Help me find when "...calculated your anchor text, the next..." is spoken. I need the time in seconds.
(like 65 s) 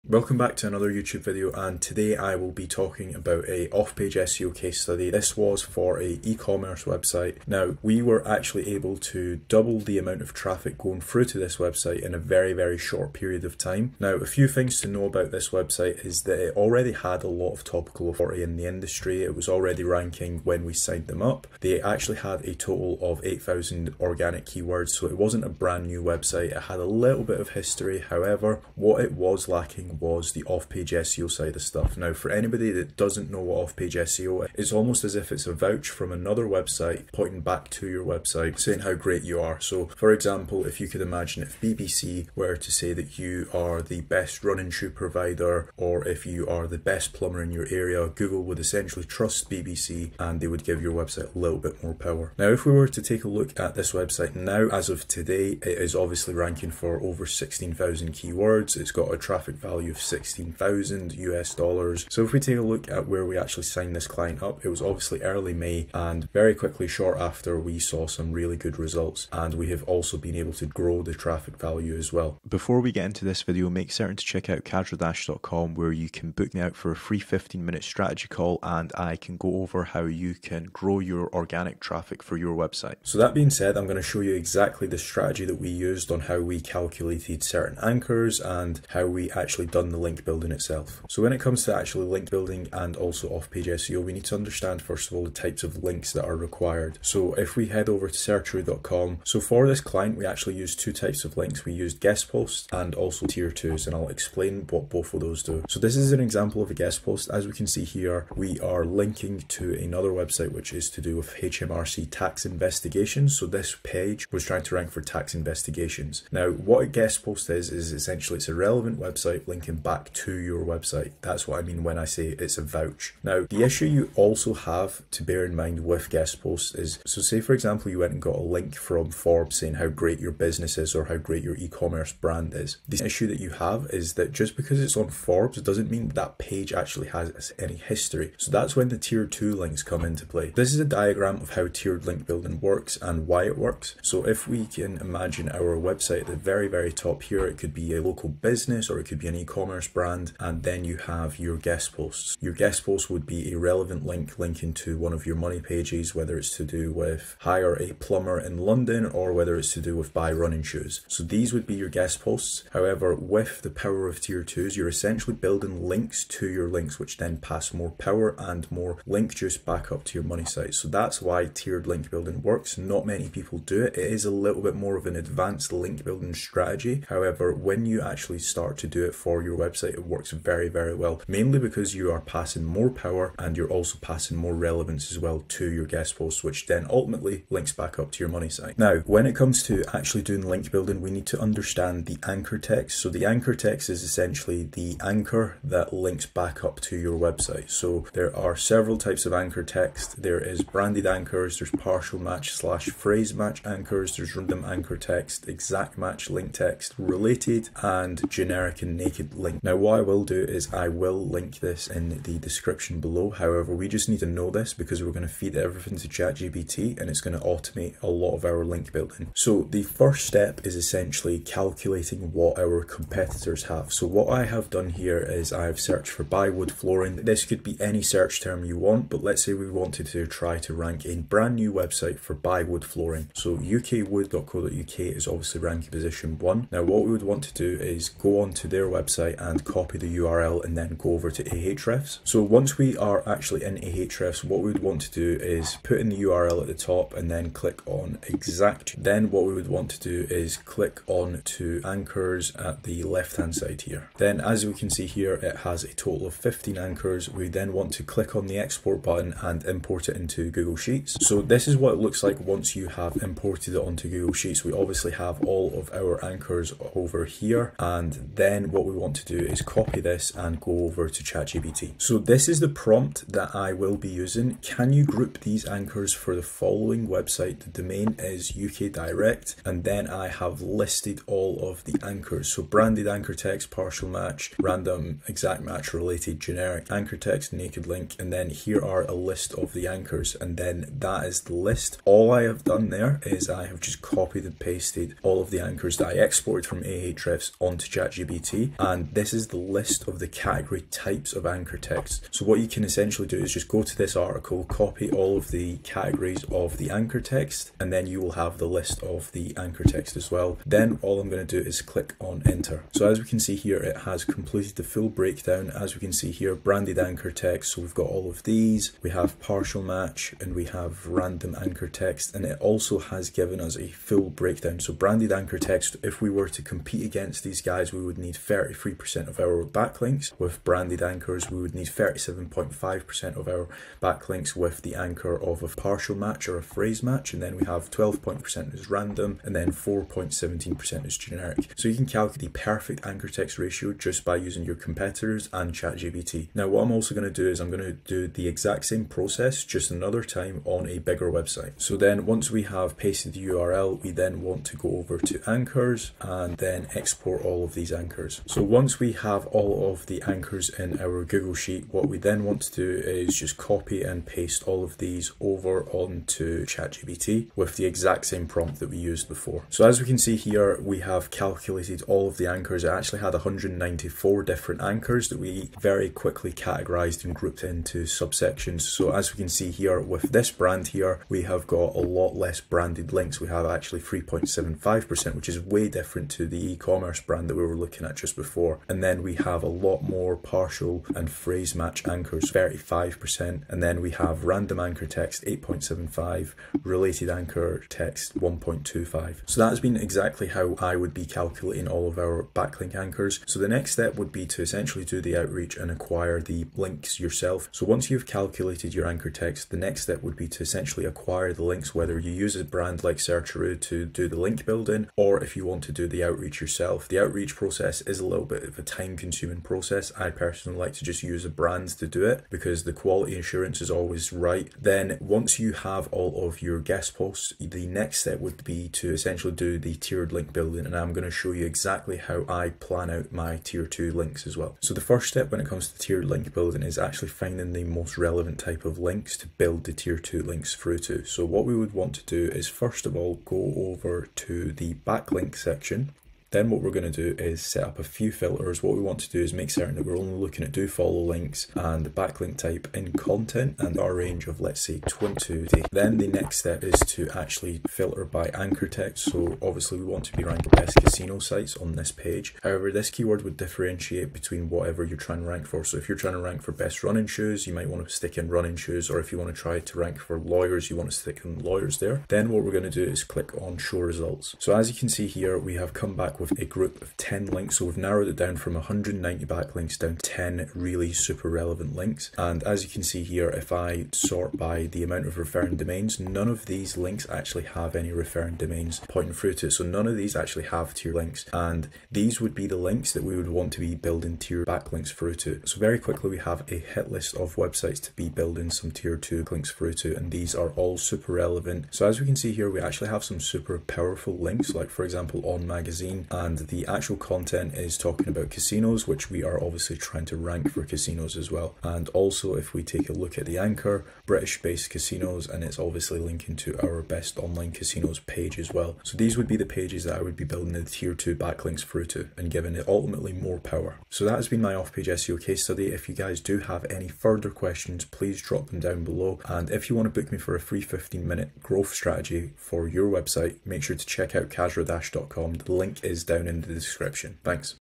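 408 s.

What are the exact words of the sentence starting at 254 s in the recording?
Then as we can see here, it has a total of 15 anchors.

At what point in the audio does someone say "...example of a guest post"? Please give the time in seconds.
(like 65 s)
106 s.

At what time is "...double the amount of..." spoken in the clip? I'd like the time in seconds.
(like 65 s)
9 s.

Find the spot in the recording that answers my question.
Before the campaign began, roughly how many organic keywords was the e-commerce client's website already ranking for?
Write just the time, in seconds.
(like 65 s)
23 s.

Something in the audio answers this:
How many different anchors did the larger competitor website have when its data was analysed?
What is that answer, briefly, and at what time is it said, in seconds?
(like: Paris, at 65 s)
194, at 373 s.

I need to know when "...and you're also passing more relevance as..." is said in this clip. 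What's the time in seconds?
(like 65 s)
183 s.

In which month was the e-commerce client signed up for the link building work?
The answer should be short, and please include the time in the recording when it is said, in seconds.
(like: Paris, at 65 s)
May, at 65 s.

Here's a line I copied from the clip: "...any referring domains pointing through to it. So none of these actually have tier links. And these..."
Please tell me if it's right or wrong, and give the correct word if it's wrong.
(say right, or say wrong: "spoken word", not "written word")
right.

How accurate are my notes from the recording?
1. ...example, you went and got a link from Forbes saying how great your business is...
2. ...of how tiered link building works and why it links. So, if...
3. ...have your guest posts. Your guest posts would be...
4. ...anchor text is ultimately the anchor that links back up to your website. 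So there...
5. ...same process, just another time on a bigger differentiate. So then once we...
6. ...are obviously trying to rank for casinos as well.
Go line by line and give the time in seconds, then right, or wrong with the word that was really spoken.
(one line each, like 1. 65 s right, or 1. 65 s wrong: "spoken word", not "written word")
1. 127 s right
2. 141 s wrong: "works", not "links"
3. 150 s right
4. 193 s wrong: "essentially", not "ultimately"
5. 348 s wrong: "website", not "differentiate"
6. 509 s right.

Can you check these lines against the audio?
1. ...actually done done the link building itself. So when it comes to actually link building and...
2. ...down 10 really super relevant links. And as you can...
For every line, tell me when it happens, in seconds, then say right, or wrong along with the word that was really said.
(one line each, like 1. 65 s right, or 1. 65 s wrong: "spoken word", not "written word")
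1. 89 s right
2. 479 s right.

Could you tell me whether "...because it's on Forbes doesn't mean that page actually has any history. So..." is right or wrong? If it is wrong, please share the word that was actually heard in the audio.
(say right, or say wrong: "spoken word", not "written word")
right.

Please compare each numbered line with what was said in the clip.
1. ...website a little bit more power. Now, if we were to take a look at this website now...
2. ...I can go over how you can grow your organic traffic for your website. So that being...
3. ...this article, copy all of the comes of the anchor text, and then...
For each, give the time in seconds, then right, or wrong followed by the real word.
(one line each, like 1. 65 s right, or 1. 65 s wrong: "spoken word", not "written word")
1. 50 s right
2. 78 s right
3. 303 s wrong: "categories", not "comes".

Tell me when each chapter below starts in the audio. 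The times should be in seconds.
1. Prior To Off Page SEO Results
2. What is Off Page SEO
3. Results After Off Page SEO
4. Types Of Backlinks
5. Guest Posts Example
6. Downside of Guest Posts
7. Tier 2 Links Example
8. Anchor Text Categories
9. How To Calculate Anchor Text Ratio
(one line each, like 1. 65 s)
1. 14 s
2. 30 s
3. 50 s
4. 90 s
5. 106 s
6. 124 s
7. 142 s
8. 191 s
9. 220 s.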